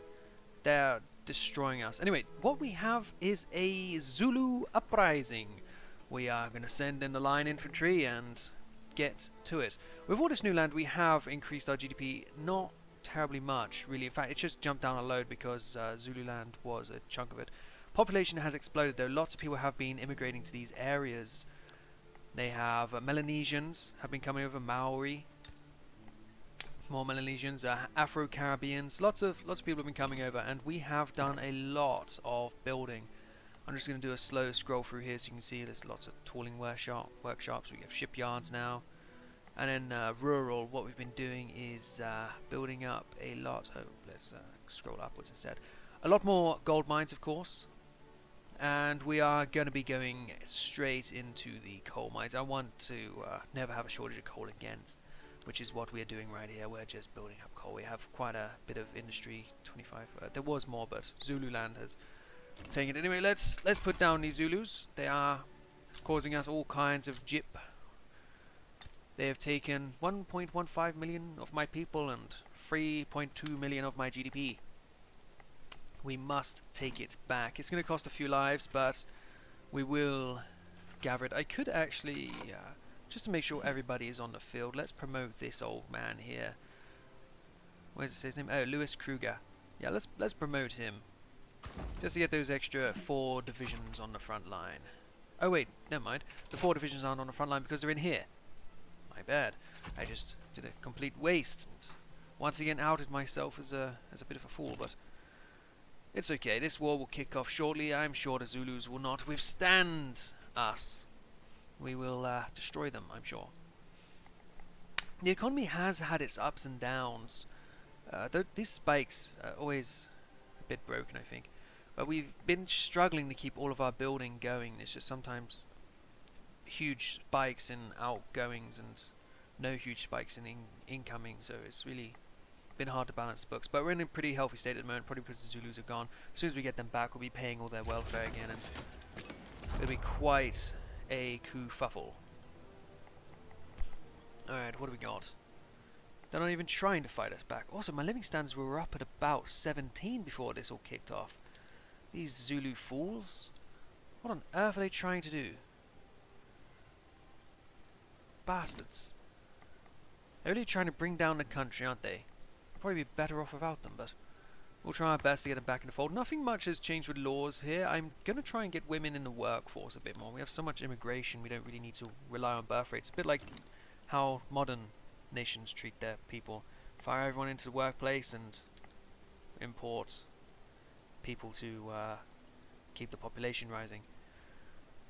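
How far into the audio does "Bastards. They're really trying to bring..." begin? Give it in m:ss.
2:38.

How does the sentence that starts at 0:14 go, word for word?
In fact, it's just jumped down a load because uh, Zululand was a chunk of it.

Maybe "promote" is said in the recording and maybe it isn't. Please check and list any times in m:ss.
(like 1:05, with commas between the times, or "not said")
1:24, 1:30.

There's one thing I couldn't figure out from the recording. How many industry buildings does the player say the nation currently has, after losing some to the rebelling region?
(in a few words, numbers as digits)
25.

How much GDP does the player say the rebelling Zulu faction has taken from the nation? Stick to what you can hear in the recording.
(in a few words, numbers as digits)
3.2 million.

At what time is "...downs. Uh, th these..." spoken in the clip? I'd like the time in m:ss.
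1:56.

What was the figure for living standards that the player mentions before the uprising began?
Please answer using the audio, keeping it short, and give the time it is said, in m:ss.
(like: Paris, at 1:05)
17, at 2:29.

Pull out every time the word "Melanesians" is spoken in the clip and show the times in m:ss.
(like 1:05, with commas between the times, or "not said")
0:22, 0:27.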